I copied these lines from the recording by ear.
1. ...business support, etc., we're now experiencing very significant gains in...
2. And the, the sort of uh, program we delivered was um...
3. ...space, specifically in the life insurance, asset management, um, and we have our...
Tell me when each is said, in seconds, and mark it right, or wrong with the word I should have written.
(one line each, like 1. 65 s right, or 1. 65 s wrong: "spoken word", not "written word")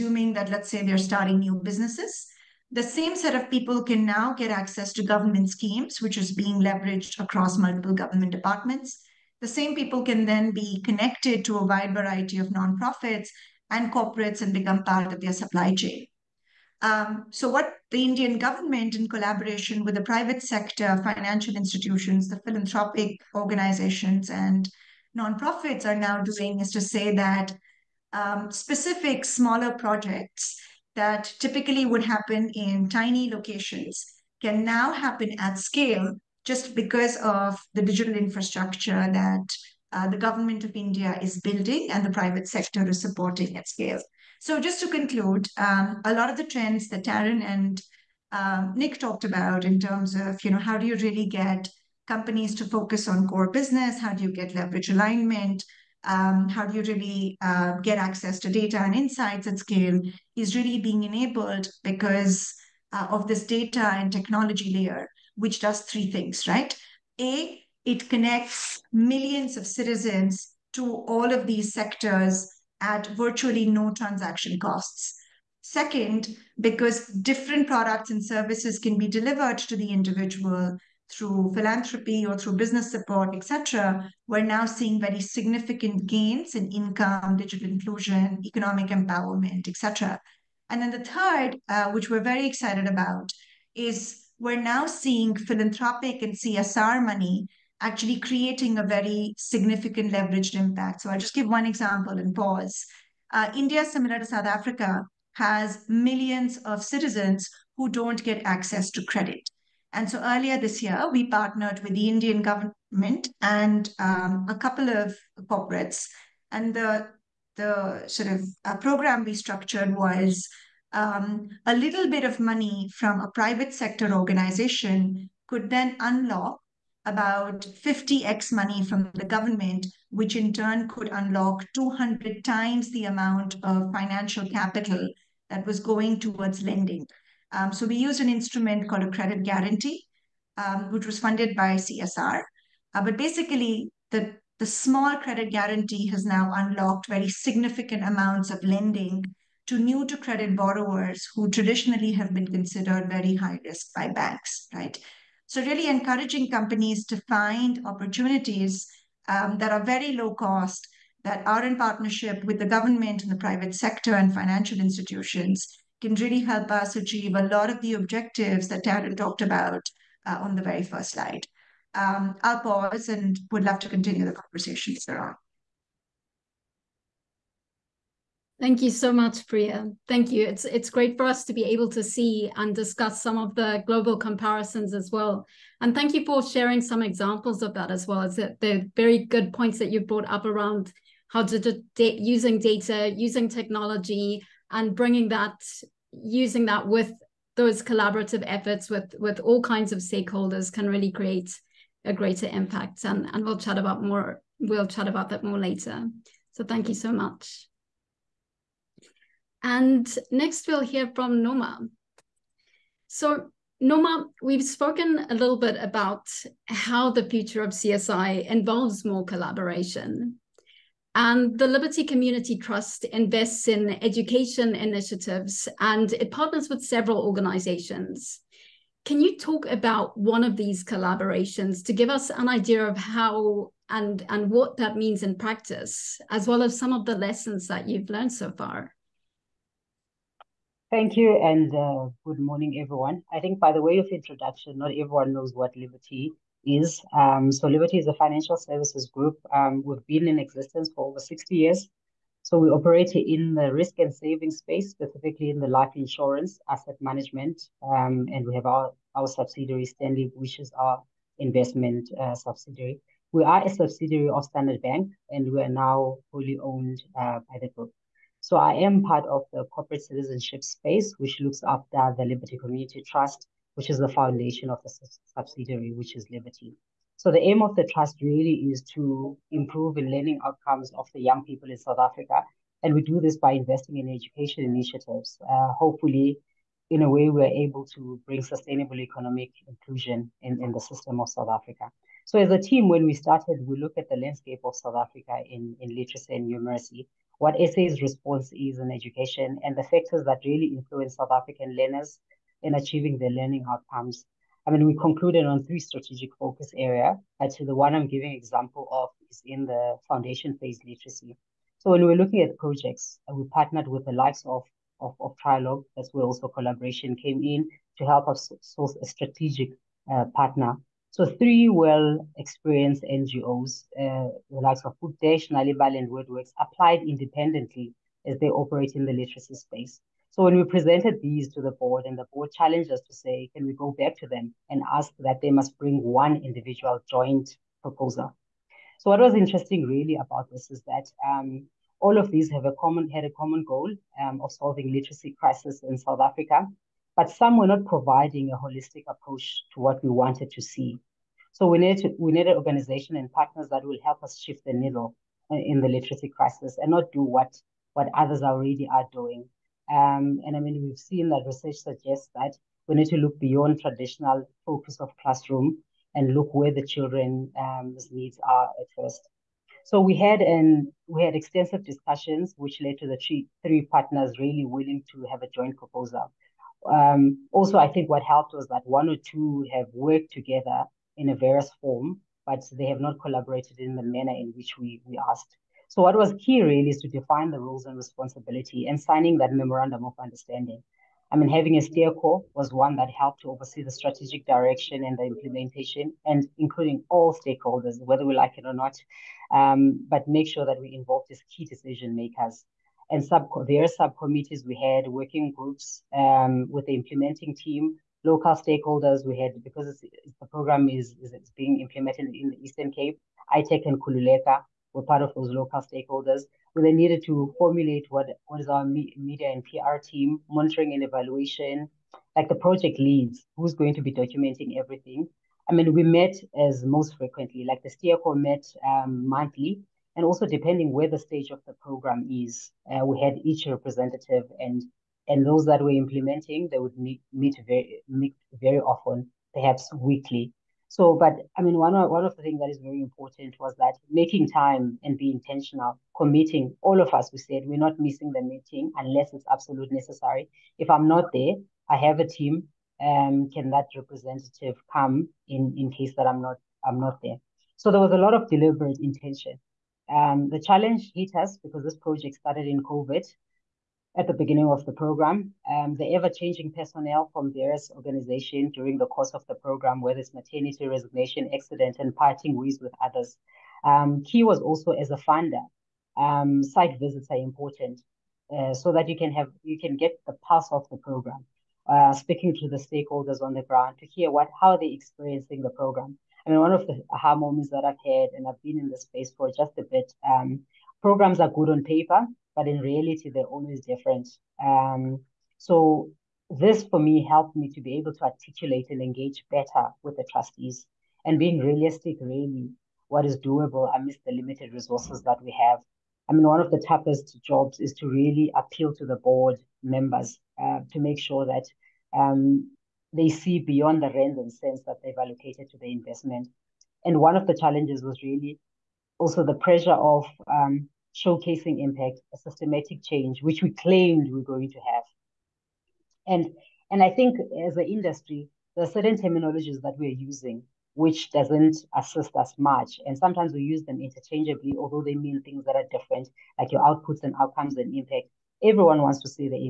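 1. 82 s wrong: "seeing", not "experiencing"
2. 116 s wrong: "structured", not "delivered"
3. 254 s right.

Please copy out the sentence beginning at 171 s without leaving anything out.
Um, I'll pause and would love to continue the conversation later on.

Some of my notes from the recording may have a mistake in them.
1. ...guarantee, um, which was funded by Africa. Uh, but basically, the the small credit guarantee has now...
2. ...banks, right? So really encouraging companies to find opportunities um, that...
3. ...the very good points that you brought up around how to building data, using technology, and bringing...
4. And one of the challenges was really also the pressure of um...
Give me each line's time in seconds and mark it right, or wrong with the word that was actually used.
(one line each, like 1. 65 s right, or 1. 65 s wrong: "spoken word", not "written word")
1. 139 s wrong: "CSR", not "Africa"
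2. 154 s right
3. 188 s wrong: "using", not "building"
4. 517 s right.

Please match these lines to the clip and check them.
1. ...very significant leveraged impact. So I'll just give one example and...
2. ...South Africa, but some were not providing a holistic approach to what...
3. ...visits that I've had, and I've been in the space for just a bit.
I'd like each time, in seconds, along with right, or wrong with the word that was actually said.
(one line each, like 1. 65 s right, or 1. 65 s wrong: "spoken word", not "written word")
1. 98 s right
2. 345 s right
3. 487 s wrong: "moments", not "visits".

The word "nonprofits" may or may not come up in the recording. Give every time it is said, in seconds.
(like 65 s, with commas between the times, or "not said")
12 s, 25 s.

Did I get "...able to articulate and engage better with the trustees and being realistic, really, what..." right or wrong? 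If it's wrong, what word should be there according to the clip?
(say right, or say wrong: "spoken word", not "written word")
right.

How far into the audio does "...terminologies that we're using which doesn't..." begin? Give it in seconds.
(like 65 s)
529 s.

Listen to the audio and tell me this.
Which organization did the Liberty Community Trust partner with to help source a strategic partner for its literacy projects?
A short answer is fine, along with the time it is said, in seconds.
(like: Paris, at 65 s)
Trialogue, at 315 s.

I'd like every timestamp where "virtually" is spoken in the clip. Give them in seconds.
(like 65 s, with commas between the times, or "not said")
73 s.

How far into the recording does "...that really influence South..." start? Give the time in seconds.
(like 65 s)
300 s.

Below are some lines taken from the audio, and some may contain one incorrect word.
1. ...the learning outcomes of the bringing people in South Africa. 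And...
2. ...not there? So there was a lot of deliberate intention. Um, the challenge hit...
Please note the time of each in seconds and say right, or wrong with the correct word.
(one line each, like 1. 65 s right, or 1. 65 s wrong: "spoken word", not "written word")
1. 279 s wrong: "young", not "bringing"
2. 456 s right.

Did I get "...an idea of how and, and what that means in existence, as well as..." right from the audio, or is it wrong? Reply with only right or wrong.
wrong.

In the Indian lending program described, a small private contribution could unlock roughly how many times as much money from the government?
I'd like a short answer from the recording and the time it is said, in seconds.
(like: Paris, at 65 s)
50x, at 127 s.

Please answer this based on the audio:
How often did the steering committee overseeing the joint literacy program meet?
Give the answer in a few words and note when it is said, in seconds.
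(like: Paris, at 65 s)
Monthly, at 429 s.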